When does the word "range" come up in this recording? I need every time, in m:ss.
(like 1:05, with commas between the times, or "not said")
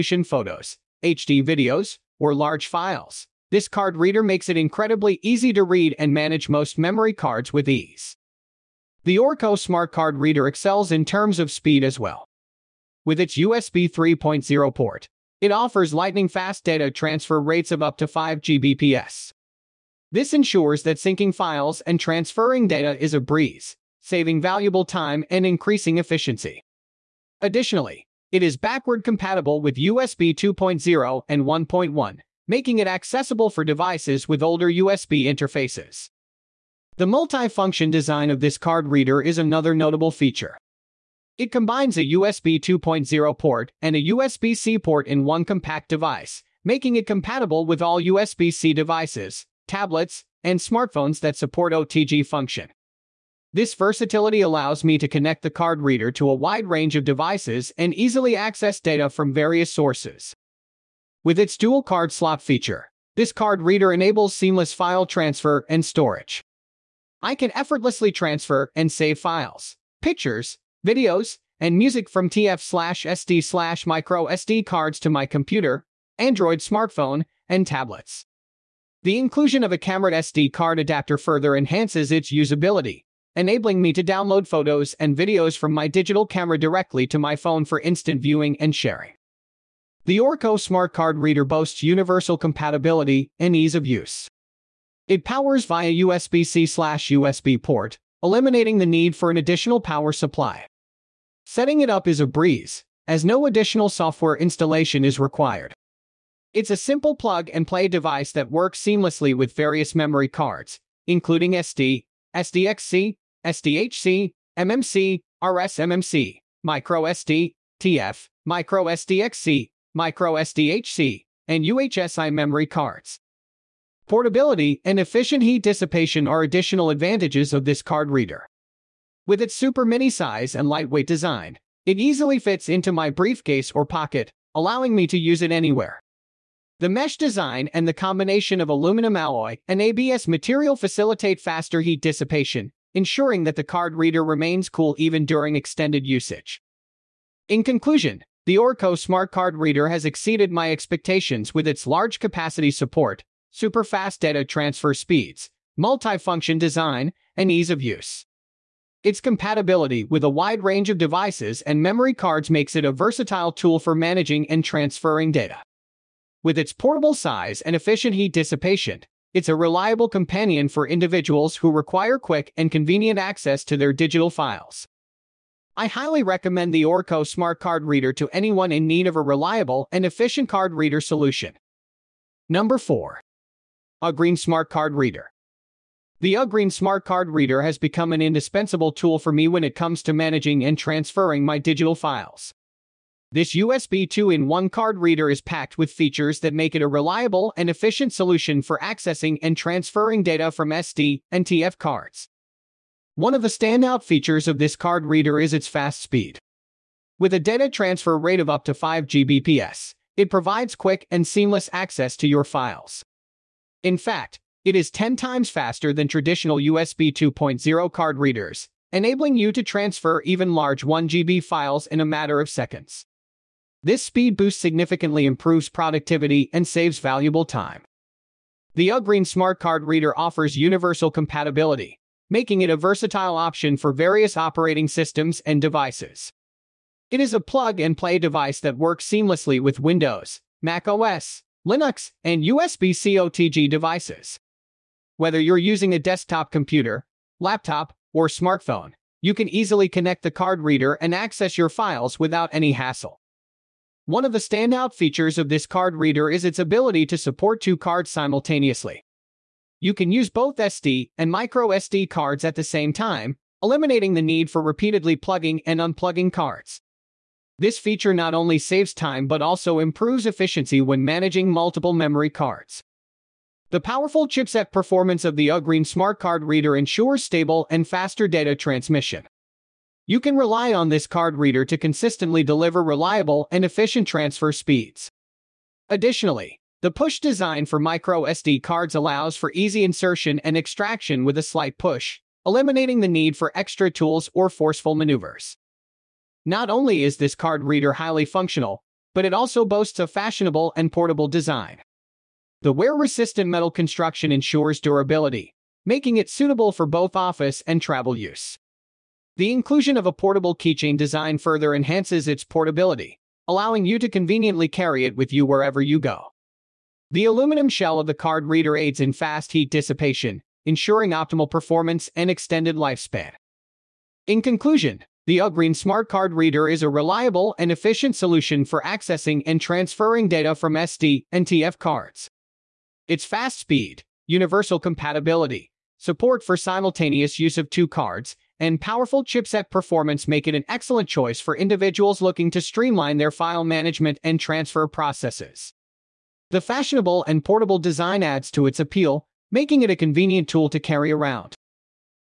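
0:56, 2:40.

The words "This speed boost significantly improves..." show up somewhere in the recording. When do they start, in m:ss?
3:43.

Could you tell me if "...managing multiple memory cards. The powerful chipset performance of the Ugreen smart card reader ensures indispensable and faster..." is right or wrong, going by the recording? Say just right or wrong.
wrong.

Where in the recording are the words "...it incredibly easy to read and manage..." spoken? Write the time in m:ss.
0:04.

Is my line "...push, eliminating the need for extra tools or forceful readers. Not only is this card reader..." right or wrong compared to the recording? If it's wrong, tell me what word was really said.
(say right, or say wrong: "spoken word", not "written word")
wrong: "maneuvers", not "readers".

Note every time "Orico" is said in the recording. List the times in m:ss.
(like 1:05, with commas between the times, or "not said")
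0:09, 1:30, 2:28, 2:56.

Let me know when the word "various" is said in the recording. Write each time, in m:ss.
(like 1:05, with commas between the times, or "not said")
0:59, 1:49, 3:53.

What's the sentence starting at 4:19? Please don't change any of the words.
You can use both SD and micro SD cards at the same time, eliminating the need for repeatedly plugging and unplugging cards.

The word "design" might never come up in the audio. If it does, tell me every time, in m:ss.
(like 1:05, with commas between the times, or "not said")
0:37, 2:11, 2:17, 2:36, 4:47, 5:01, 5:10, 5:47.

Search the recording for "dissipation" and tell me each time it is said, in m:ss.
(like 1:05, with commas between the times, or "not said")
2:05, 2:22, 2:48, 5:19.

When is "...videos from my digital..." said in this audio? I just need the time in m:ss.
1:25.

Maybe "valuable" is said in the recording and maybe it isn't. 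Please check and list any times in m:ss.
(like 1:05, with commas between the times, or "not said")
0:24, 3:46.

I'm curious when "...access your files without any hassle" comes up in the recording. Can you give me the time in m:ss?
4:11.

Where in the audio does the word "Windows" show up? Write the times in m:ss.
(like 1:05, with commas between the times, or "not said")
3:59.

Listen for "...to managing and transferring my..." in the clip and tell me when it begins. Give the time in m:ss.
3:10.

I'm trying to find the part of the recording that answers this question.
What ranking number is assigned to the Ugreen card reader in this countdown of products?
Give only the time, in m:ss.
3:02.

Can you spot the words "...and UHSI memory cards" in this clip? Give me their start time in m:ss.
2:01.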